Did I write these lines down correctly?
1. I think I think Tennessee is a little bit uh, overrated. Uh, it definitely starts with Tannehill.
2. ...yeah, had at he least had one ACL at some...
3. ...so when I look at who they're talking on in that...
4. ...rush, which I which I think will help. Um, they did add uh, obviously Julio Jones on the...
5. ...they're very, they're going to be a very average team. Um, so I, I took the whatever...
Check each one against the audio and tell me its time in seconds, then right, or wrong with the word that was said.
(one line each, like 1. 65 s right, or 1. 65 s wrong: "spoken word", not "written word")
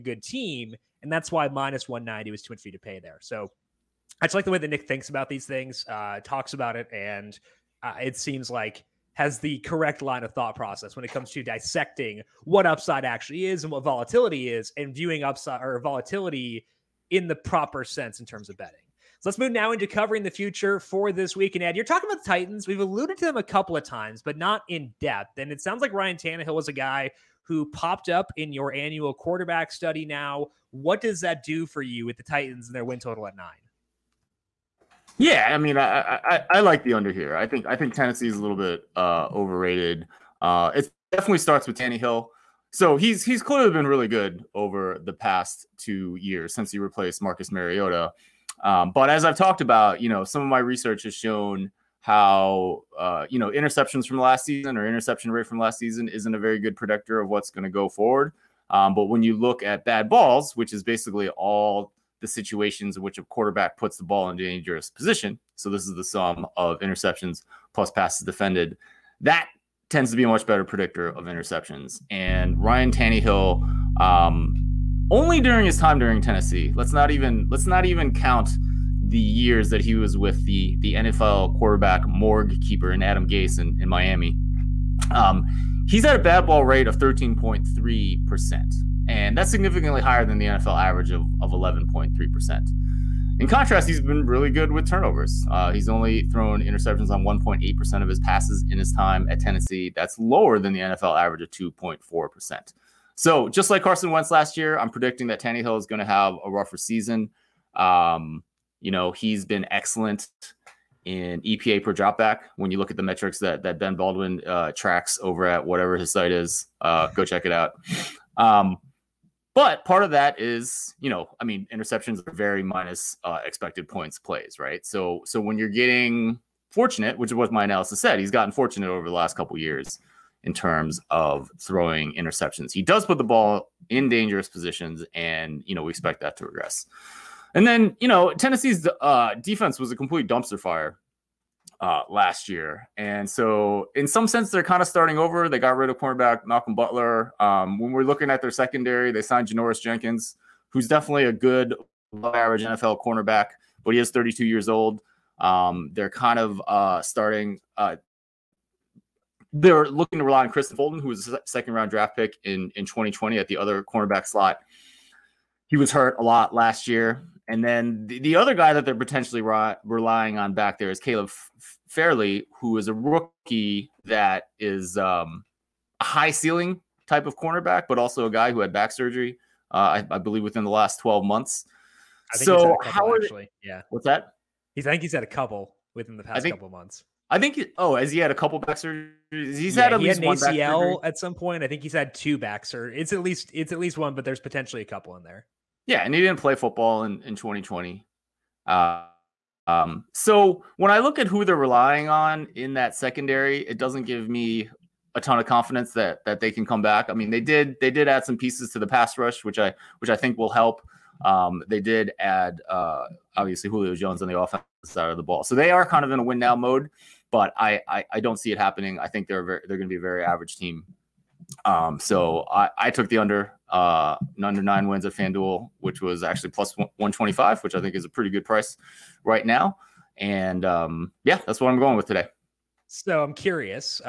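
1. 37 s right
2. 189 s right
3. 200 s wrong: "relying", not "talking"
4. 209 s right
5. 219 s wrong: "under", not "whatever".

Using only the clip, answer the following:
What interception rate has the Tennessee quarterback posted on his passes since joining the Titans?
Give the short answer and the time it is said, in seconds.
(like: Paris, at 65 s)
1.8%, at 97 s.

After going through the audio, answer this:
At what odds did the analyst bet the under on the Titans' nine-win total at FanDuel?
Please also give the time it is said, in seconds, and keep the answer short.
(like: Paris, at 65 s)
+125, at 226 s.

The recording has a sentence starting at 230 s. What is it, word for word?
And um, yeah, that's what I'm going with today.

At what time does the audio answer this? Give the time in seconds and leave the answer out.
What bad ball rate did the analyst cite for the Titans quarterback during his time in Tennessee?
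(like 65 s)
86 s.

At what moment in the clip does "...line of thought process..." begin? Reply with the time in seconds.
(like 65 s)
10 s.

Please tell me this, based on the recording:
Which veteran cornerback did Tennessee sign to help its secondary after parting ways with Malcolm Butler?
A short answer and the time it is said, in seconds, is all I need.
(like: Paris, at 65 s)
Janoris Jenkins, at 149 s.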